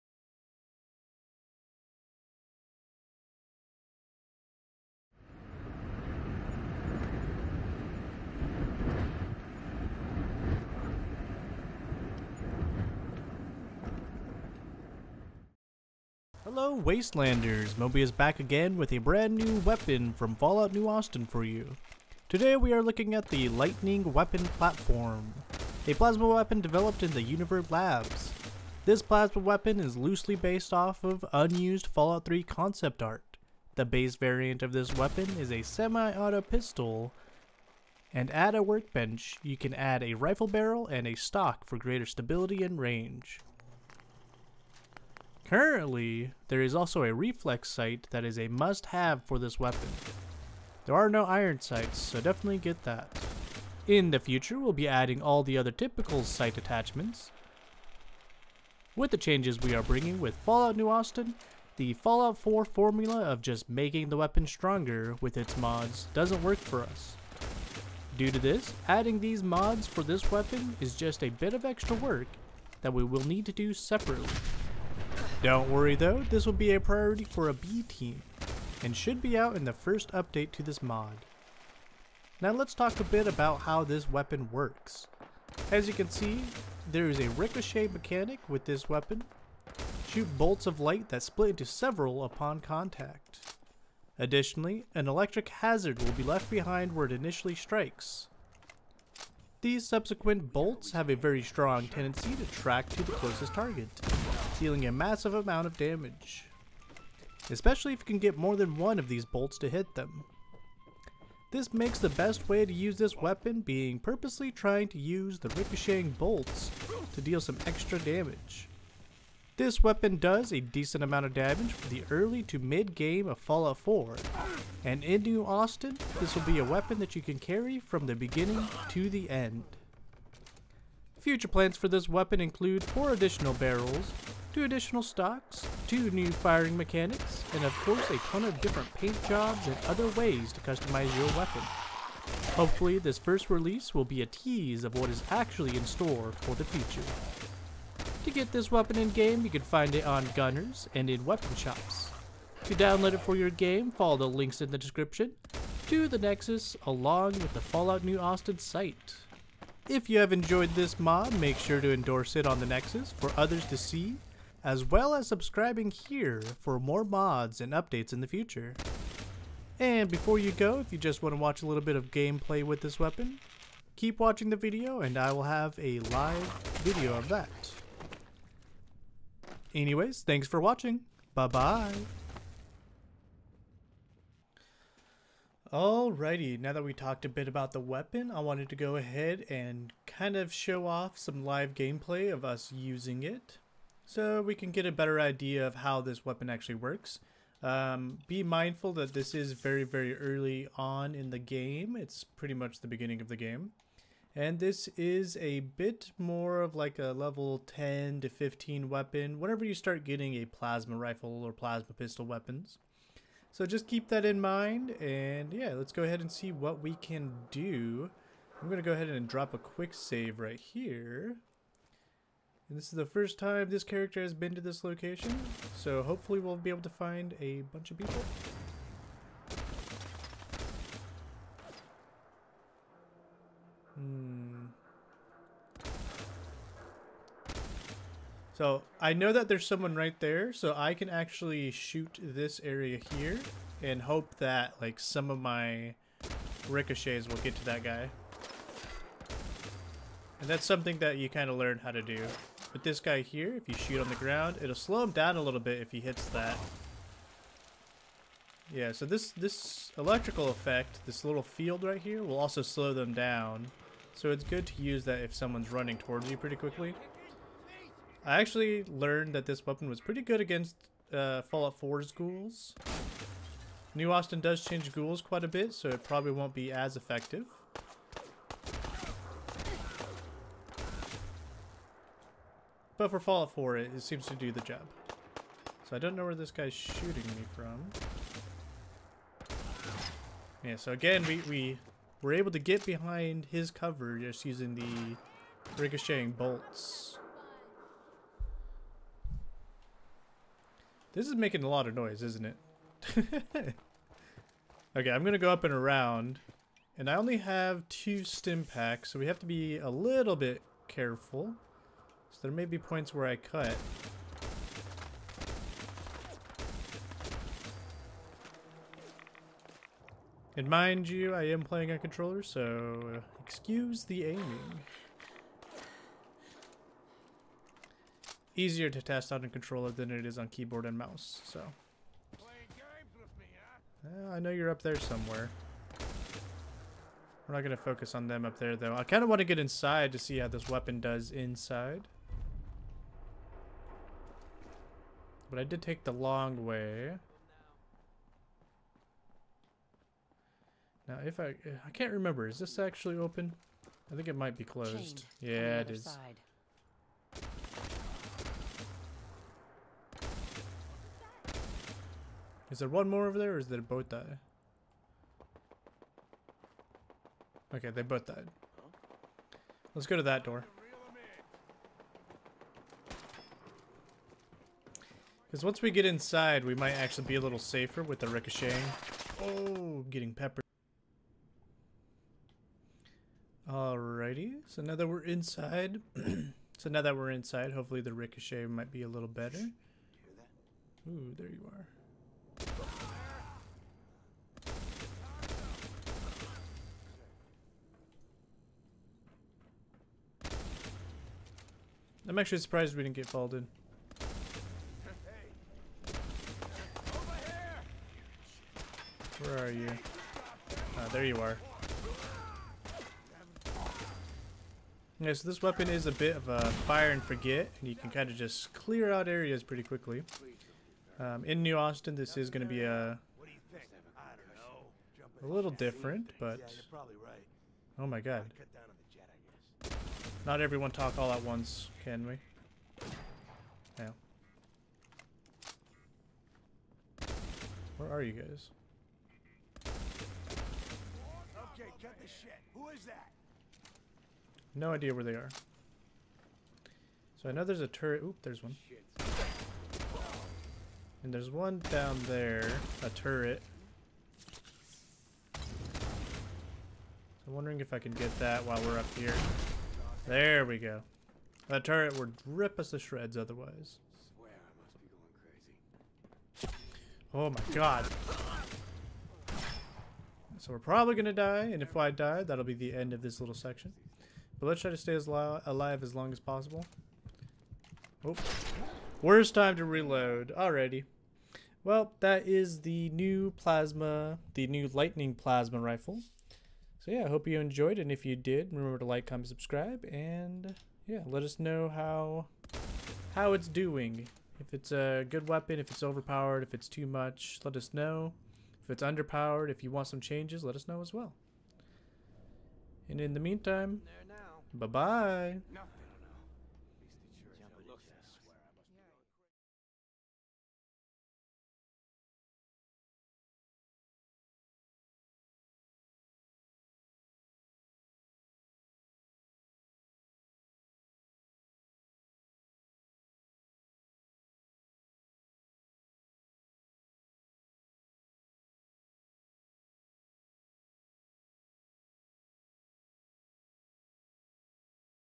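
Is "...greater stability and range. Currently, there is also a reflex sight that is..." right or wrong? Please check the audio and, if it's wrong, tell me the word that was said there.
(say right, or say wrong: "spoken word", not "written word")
right.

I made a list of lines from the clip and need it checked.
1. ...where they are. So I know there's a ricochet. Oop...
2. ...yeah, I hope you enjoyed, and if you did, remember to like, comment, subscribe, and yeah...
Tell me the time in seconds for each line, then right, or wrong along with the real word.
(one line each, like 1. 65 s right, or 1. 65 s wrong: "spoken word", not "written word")
1. 445 s wrong: "turret", not "ricochet"
2. 487 s right.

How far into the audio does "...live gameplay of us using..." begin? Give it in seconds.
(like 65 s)
191 s.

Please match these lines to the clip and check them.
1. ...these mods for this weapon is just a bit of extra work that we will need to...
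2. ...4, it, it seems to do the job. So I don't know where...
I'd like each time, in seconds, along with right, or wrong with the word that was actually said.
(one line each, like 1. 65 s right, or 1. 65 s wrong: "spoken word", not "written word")
1. 69 s right
2. 283 s right.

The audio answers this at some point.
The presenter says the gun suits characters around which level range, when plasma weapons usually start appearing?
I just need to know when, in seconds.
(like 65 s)
207 s.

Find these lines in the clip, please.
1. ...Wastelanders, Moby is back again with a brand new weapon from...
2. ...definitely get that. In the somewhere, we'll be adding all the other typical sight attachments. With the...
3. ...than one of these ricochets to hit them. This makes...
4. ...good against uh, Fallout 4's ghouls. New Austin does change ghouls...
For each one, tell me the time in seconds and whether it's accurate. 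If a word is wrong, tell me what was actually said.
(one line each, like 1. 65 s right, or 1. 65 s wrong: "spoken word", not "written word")
1. 16 s right
2. 52 s wrong: "future", not "somewhere"
3. 108 s wrong: "bolts", not "ricochets"
4. 270 s right.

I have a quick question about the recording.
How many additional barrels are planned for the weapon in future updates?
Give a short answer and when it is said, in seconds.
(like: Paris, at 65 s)
4, at 132 s.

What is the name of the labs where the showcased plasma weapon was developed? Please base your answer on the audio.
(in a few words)
Universe Labs.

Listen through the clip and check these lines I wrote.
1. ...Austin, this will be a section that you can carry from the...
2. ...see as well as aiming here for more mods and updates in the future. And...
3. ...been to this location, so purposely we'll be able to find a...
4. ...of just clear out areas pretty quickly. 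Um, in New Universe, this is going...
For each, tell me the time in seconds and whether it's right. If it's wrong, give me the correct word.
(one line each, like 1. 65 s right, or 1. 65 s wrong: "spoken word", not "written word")
1. 125 s wrong: "weapon", not "section"
2. 163 s wrong: "subscribing", not "aiming"
3. 224 s wrong: "hopefully", not "purposely"
4. 418 s wrong: "Austin", not "Universe".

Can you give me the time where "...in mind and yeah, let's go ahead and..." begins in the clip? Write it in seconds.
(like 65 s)
214 s.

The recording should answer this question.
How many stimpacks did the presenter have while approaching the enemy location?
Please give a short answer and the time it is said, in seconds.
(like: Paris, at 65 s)
2, at 307 s.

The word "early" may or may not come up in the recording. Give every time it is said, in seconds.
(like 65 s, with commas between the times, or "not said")
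122 s, 200 s.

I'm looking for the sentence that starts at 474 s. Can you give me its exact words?
But let's try to stay as alive as long as possible.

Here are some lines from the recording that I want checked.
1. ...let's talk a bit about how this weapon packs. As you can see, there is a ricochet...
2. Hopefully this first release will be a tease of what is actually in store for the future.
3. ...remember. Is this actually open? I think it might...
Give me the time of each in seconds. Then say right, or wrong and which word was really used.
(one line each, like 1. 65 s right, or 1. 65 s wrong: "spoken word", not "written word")
1. 82 s wrong: "works", not "packs"
2. 142 s right
3. 352 s right.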